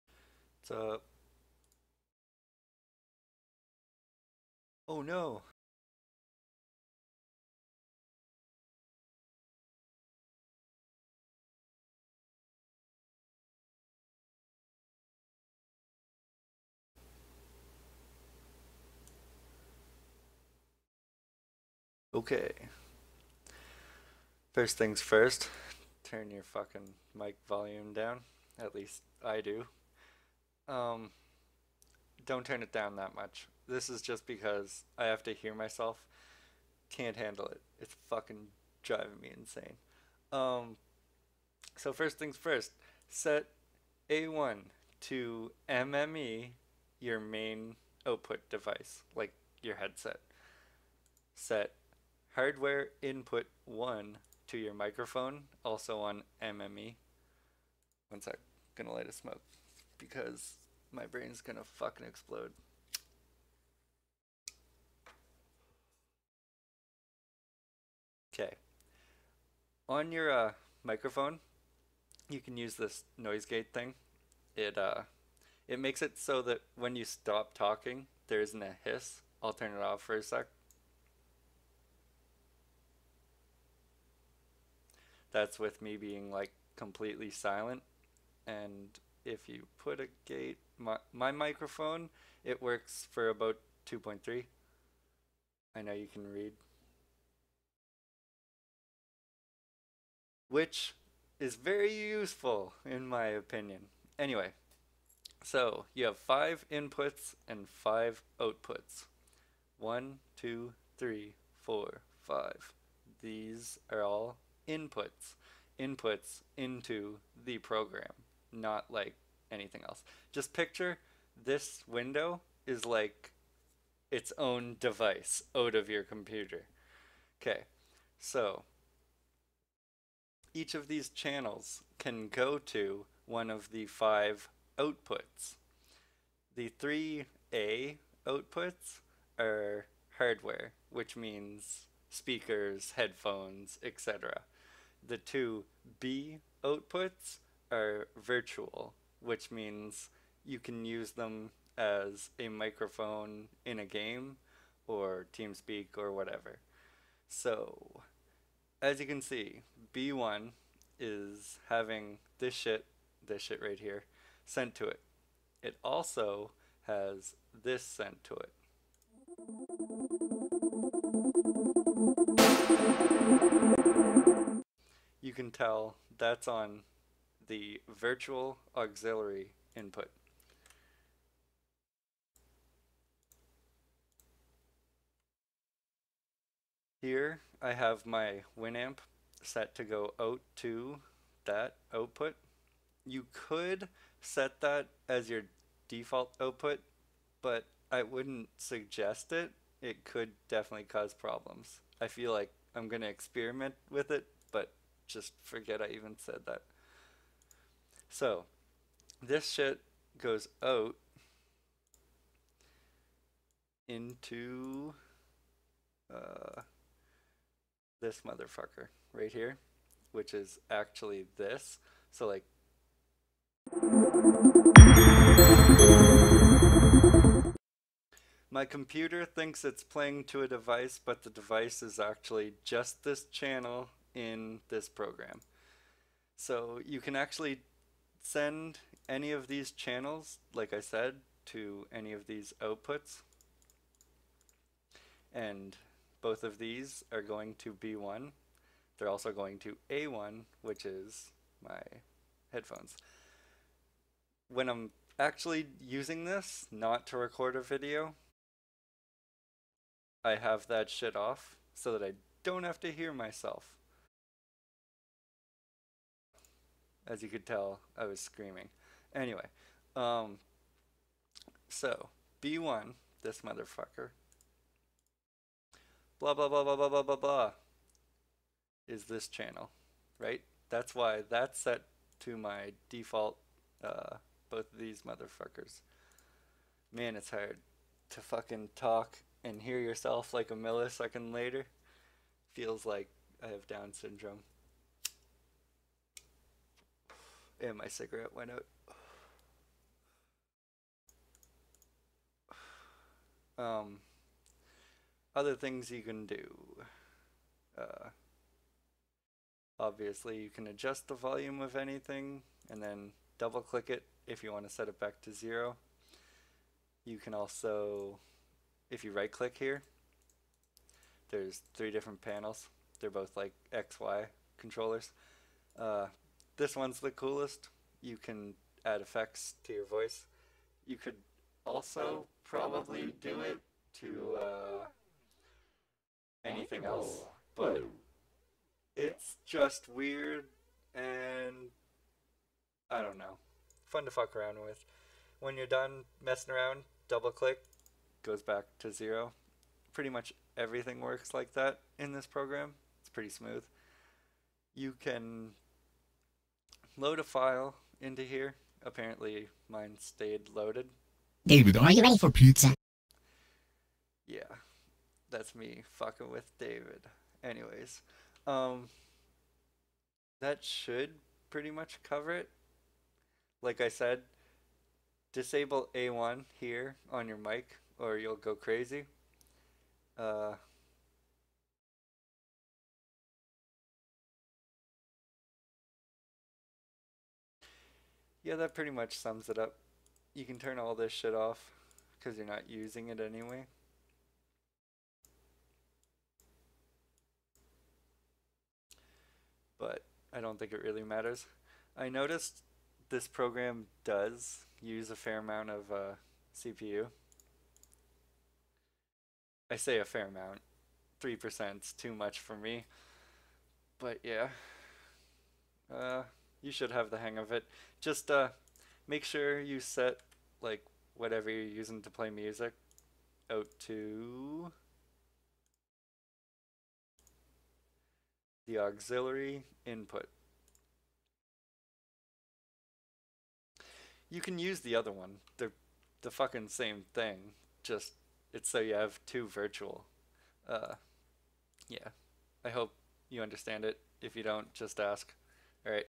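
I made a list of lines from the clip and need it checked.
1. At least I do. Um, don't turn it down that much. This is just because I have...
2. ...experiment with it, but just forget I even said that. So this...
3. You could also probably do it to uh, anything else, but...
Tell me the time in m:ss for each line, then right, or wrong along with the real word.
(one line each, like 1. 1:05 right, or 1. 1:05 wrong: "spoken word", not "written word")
1. 0:28 right
2. 3:23 right
3. 5:30 right.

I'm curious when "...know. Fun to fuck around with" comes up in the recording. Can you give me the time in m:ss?
5:43.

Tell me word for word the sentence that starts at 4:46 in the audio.
Man, it's hard to fucking talk and hear yourself like a millisecond later.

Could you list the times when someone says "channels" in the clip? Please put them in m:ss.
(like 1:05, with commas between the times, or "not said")
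2:11, 3:53, 3:59, 4:39.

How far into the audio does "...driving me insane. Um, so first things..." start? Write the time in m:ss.
0:38.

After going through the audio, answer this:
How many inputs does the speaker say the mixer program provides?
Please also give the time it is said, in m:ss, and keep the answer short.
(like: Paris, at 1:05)
5, at 1:46.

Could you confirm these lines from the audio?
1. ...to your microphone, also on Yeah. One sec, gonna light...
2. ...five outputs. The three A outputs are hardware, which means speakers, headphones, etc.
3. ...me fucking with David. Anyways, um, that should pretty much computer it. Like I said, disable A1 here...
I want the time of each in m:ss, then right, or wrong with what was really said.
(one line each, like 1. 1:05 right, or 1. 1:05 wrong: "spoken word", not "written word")
1. 0:54 wrong: "MME", not "Yeah"
2. 2:13 right
3. 6:05 wrong: "cover", not "computer".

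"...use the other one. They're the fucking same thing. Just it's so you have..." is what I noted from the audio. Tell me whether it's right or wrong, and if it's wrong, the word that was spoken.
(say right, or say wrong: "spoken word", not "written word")
right.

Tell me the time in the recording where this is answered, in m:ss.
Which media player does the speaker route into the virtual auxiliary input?
3:08.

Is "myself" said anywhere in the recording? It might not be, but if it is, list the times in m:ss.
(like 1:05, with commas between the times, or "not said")
0:35, 4:23.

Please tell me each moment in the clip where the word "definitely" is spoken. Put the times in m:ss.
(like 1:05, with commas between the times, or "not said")
3:20.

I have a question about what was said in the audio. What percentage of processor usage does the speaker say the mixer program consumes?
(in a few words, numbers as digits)
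3%.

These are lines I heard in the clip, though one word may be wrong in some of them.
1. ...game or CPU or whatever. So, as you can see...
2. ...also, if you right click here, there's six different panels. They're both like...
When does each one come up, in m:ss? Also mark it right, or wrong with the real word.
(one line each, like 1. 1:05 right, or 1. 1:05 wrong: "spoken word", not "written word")
1. 2:33 wrong: "TeamSpeak", not "CPU"
2. 5:17 wrong: "three", not "six".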